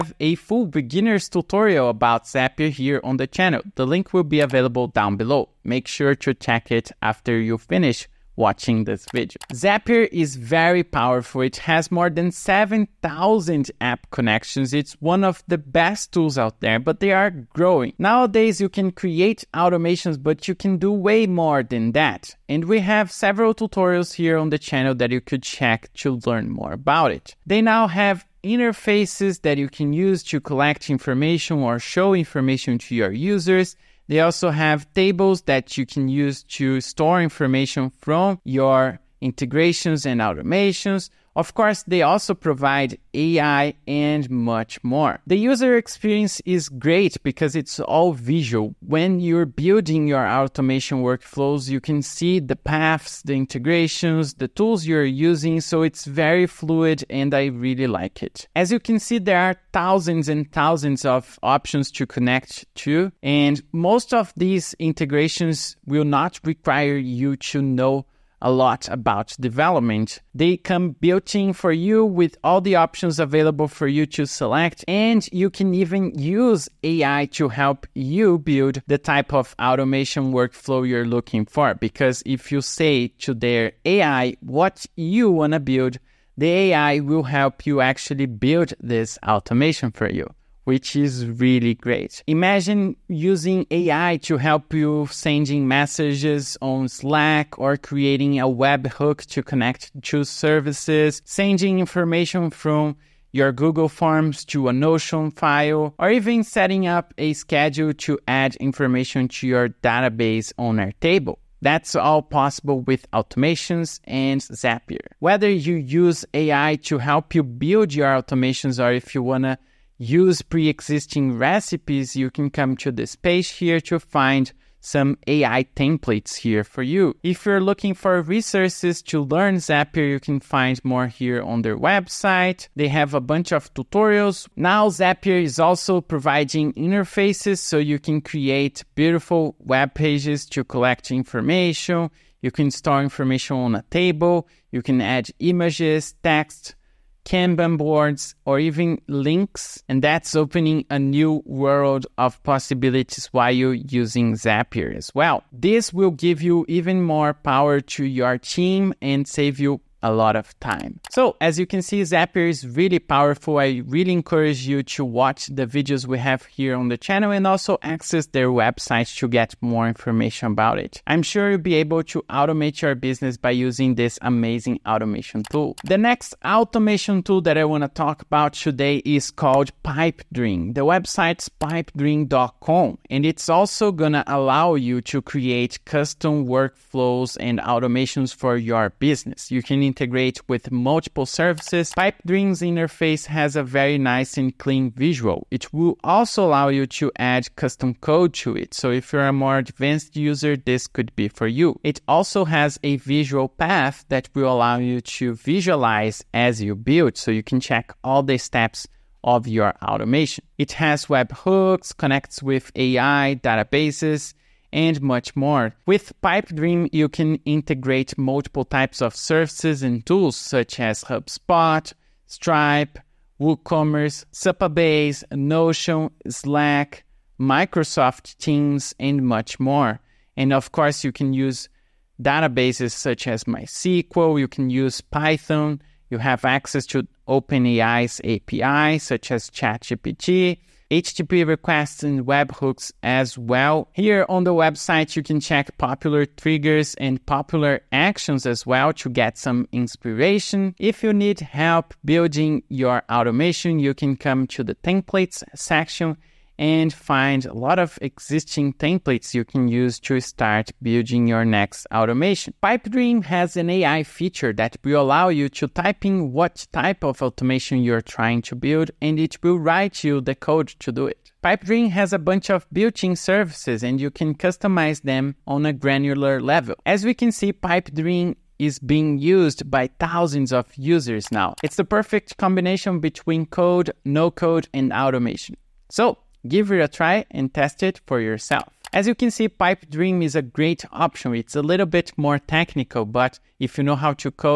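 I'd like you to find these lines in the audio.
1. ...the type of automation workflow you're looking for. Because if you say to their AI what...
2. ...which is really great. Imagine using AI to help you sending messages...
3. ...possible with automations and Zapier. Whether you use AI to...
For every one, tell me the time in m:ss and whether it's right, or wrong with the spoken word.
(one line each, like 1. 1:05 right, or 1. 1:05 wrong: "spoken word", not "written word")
1. 1:18 right
2. 1:30 right
3. 1:52 right.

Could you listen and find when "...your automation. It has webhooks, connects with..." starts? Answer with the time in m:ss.
3:29.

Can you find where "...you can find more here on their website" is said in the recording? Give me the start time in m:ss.
2:10.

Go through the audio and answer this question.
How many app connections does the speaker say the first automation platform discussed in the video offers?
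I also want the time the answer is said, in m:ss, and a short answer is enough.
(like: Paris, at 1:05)
More than 7,000, at 0:11.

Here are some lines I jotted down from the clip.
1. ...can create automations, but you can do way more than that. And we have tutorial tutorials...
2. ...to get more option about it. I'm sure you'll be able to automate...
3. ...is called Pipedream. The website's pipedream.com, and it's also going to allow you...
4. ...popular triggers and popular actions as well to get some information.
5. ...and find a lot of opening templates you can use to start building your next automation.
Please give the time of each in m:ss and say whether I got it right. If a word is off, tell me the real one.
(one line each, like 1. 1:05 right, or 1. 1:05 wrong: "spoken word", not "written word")
1. 0:18 wrong: "several", not "tutorial"
2. 2:49 wrong: "information", not "option"
3. 2:59 right
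4. 4:05 wrong: "inspiration", not "information"
5. 4:16 wrong: "existing", not "opening".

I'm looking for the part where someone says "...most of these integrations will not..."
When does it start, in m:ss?
1:03.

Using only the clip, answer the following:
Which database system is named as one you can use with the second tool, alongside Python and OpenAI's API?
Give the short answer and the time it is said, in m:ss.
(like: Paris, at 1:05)
MySQL, at 3:53.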